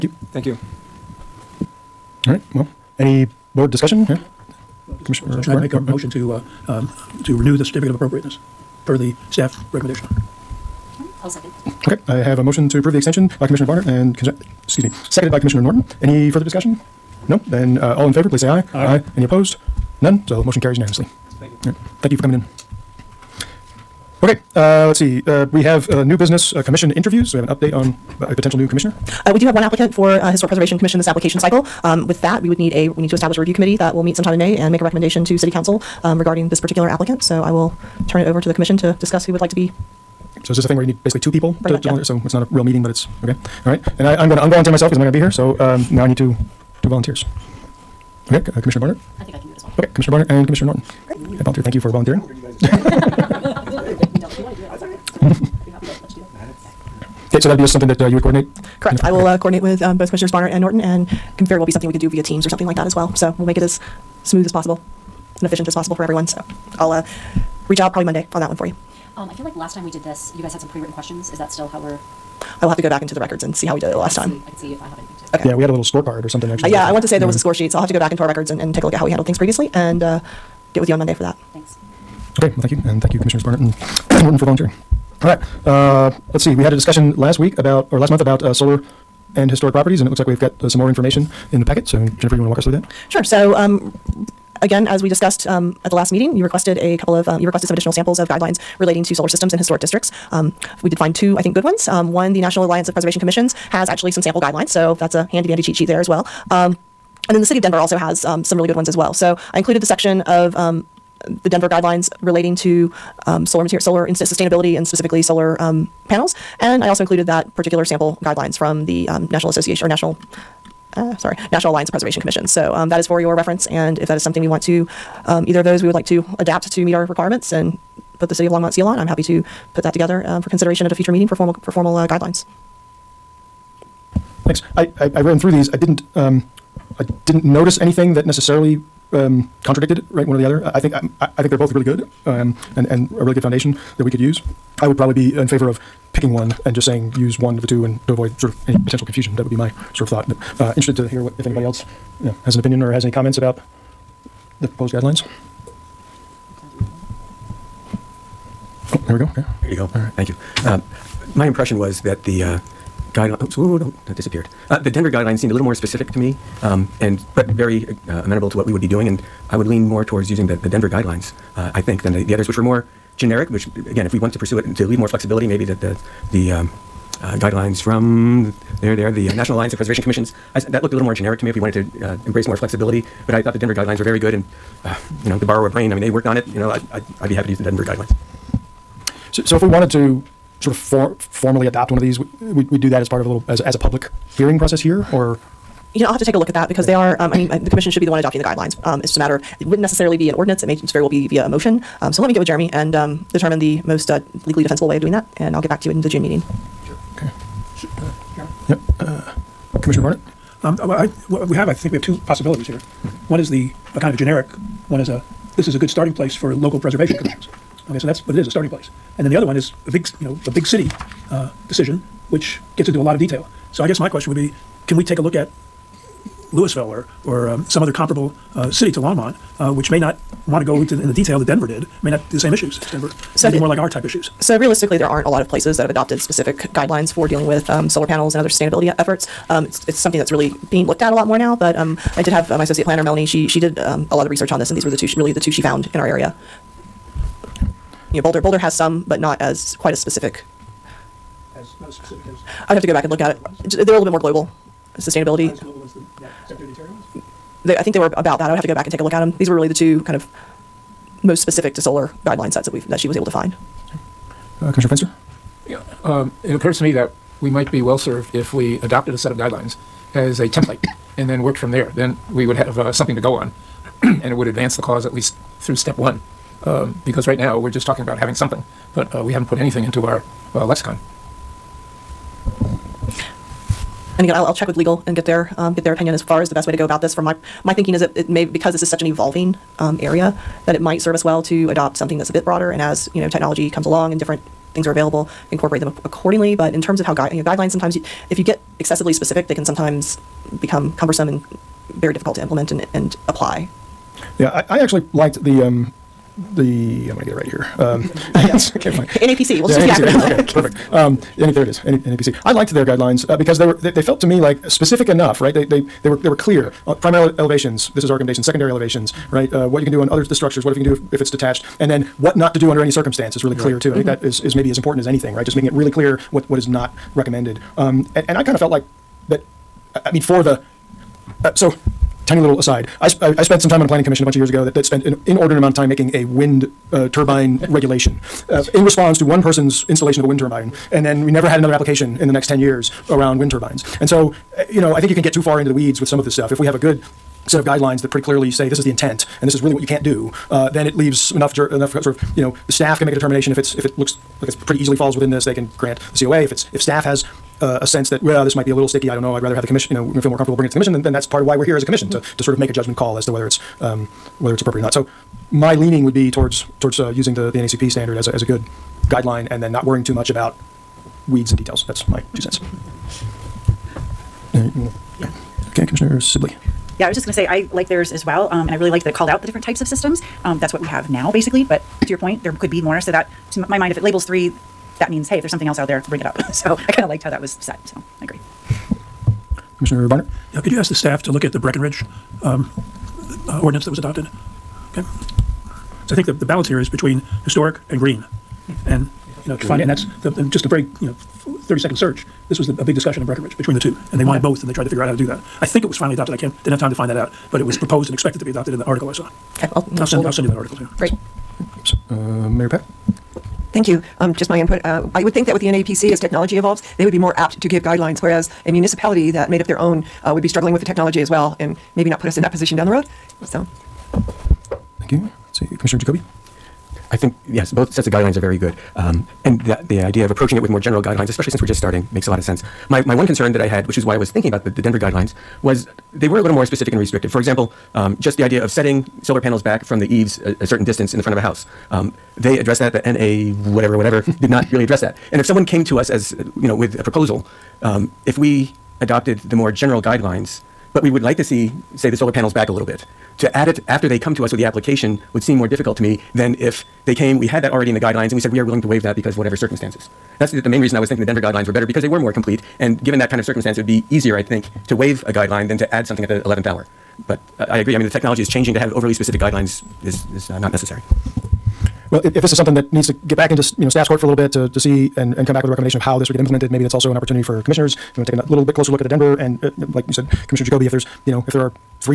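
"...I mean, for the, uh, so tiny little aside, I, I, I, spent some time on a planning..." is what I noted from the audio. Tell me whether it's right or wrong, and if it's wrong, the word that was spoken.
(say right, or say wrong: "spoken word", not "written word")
right.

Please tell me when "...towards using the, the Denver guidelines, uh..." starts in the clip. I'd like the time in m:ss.
2:50.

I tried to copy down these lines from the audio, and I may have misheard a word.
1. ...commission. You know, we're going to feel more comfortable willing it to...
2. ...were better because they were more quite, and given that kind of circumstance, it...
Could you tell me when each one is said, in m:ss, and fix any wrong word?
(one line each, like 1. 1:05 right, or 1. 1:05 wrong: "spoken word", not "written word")
1. 5:59 wrong: "bringing", not "willing"
2. 7:41 wrong: "complete", not "quite".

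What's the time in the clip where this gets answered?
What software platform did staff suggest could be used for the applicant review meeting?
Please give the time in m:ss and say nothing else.
1:02.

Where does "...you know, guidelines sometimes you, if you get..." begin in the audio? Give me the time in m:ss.
4:57.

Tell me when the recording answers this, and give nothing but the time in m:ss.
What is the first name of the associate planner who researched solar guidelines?
4:03.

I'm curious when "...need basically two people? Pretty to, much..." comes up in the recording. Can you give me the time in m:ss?
0:40.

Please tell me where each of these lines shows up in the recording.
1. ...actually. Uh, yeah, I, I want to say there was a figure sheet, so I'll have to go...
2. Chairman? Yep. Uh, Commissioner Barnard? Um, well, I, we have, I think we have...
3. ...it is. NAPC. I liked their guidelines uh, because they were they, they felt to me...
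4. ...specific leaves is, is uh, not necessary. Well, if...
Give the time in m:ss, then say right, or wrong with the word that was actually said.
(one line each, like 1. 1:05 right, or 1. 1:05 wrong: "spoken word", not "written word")
1. 1:16 wrong: "score", not "figure"
2. 3:28 right
3. 5:11 right
4. 7:49 wrong: "guidelines", not "leaves".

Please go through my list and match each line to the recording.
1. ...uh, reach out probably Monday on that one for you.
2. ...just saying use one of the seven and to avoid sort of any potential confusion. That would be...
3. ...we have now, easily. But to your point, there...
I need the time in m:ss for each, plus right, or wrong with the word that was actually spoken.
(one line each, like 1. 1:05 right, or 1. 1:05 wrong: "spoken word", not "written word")
1. 1:06 right
2. 2:26 wrong: "two", not "seven"
3. 6:20 wrong: "basically", not "easily".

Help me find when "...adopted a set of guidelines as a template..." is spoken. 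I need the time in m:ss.
4:28.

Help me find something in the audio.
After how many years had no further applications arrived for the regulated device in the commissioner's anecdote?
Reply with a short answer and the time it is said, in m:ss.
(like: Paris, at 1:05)
10, at 5:42.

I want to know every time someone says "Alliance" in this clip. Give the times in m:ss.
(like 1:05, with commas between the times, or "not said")
1:42, 2:01, 2:59.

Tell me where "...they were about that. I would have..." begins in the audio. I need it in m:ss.
4:17.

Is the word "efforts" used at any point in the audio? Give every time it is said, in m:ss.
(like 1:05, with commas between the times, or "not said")
3:58.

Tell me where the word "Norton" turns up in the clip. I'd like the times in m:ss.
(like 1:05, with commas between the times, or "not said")
0:15, 0:50, 1:00, 1:24.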